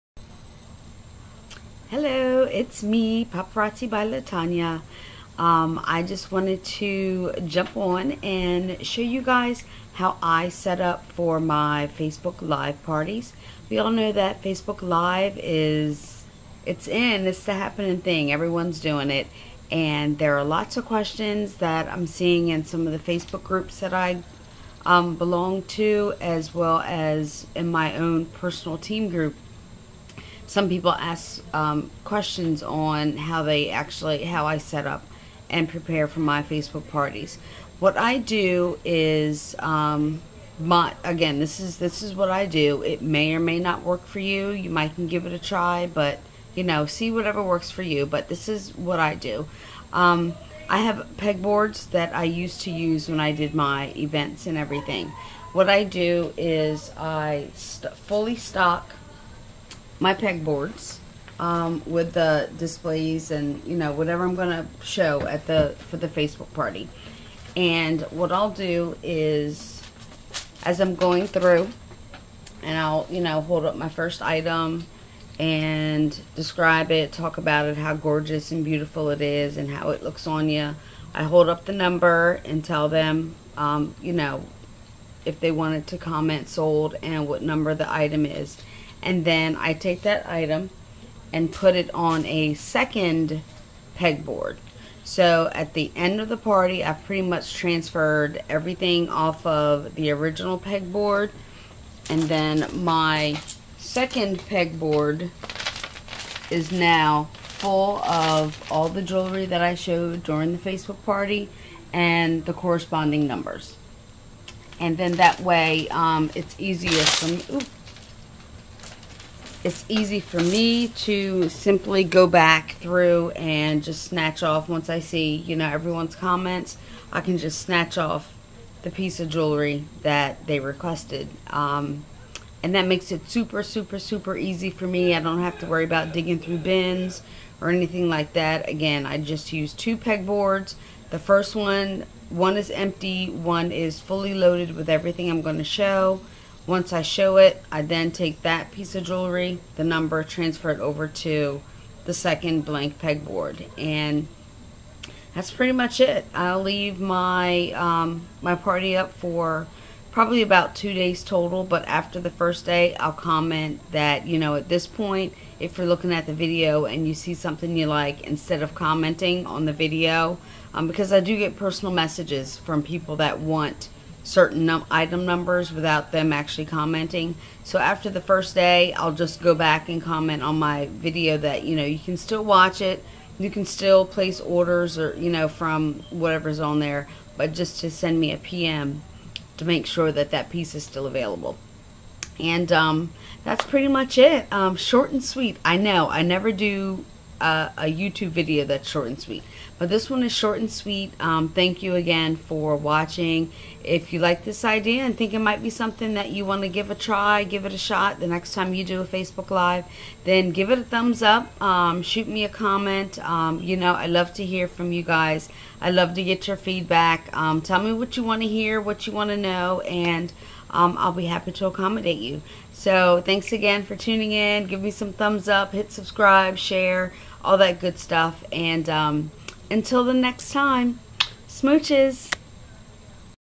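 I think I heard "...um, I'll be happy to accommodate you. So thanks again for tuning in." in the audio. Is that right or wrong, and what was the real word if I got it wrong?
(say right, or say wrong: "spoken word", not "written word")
right.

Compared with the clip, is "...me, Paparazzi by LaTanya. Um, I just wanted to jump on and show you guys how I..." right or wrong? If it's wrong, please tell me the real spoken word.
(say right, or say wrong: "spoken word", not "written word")
right.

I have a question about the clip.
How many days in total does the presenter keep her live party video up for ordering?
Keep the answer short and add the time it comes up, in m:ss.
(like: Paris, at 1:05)
2, at 2:40.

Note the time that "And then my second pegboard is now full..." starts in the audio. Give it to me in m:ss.
1:42.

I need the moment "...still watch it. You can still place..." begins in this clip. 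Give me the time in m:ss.
3:02.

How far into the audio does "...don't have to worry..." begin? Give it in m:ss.
2:15.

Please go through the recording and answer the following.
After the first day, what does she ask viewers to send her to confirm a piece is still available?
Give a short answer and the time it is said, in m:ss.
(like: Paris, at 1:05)
A PM, at 3:08.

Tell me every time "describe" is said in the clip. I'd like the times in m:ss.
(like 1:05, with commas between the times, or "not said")
1:16.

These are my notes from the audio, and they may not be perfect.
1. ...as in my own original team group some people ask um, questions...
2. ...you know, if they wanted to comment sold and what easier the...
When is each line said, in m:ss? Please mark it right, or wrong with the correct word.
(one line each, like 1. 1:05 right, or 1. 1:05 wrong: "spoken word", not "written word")
1. 0:26 wrong: "personal", not "original"
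2. 1:24 wrong: "number", not "easier".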